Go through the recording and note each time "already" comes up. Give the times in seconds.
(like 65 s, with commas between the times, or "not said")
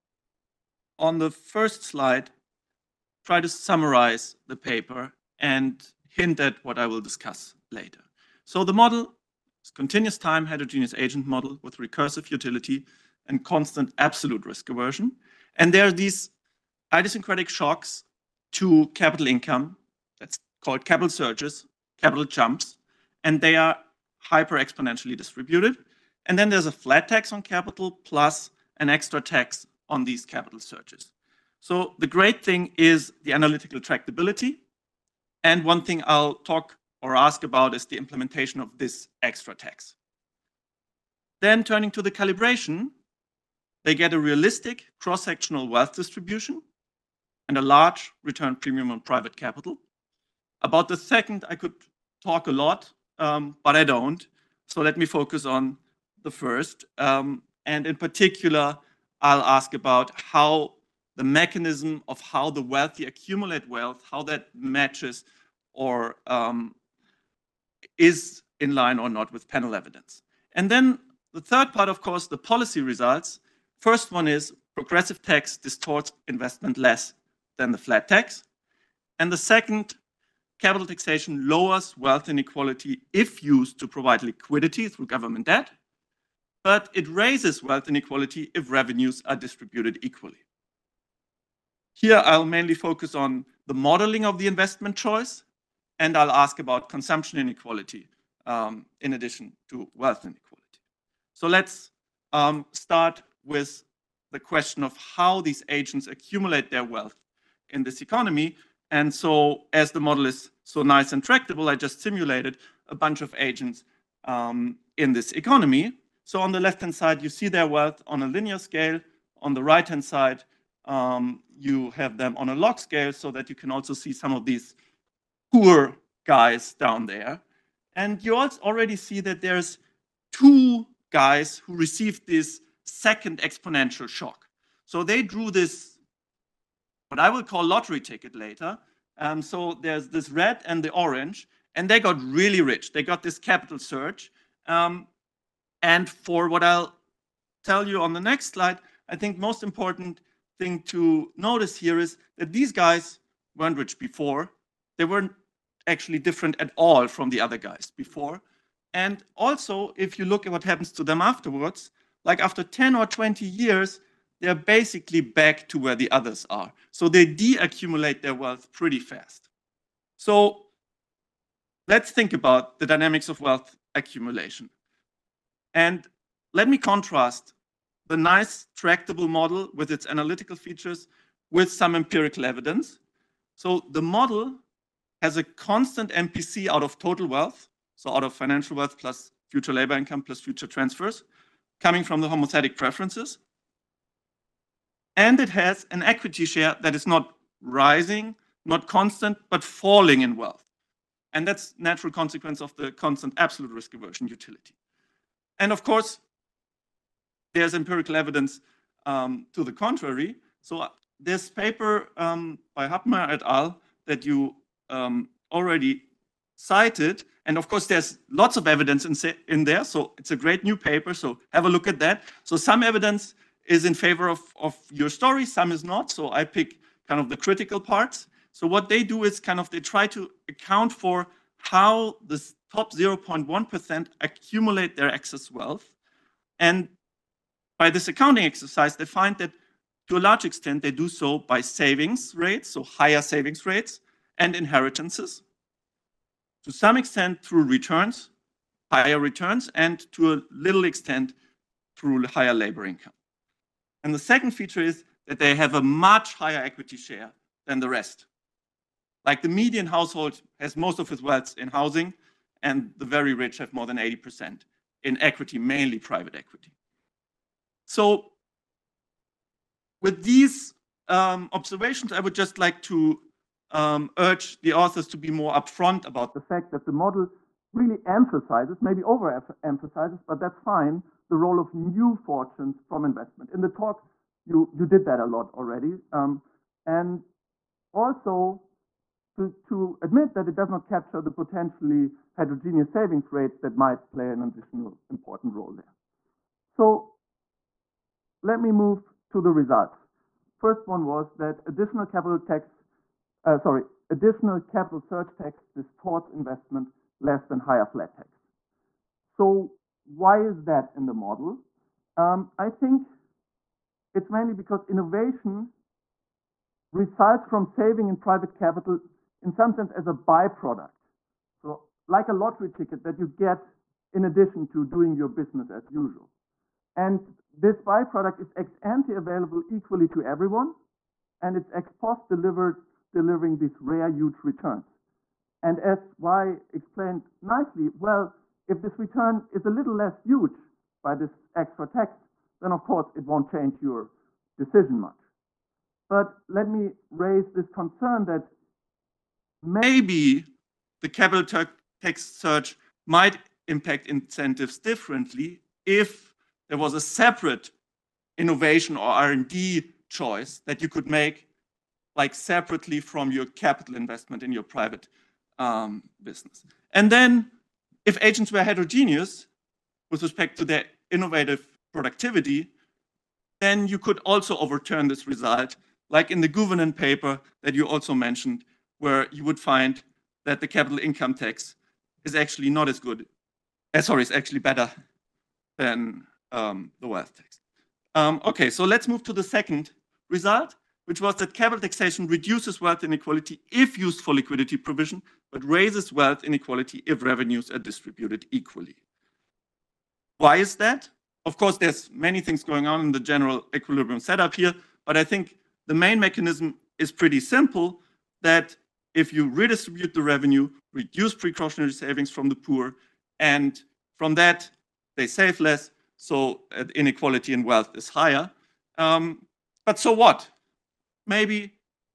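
128 s, 215 s, 285 s.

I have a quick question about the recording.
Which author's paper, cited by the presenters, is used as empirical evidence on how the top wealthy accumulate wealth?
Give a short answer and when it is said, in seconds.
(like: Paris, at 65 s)
Hubmer, at 212 s.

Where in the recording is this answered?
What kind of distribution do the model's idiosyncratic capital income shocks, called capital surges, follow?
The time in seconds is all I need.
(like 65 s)
24 s.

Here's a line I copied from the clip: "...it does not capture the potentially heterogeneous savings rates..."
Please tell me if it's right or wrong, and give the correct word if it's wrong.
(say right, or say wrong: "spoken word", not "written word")
right.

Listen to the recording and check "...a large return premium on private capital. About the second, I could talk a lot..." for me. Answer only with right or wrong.
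right.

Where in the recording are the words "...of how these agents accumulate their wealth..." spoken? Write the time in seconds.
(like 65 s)
104 s.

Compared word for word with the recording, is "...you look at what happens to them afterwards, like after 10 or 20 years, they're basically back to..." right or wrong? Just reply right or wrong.
right.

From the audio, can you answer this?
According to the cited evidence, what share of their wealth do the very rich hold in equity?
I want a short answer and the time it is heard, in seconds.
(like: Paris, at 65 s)
More than 80%, at 263 s.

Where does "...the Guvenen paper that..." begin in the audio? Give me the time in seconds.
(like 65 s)
376 s.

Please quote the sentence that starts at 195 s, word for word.
And it has an equity share that is not rising, not constant, but falling in wealth.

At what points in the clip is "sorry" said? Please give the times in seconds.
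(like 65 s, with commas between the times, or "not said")
303 s, 384 s.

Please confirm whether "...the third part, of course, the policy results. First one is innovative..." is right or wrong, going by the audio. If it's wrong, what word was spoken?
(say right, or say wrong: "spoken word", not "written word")
wrong: "progressive", not "innovative".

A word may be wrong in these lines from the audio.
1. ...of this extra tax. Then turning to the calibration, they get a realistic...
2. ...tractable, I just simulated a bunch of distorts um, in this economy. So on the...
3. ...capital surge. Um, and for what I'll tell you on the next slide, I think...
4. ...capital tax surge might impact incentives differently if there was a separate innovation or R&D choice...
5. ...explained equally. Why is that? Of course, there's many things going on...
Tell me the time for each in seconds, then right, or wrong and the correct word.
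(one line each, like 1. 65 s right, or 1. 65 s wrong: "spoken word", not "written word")
1. 38 s right
2. 111 s wrong: "agents", not "distorts"
3. 143 s right
4. 351 s right
5. 397 s wrong: "distributed", not "explained".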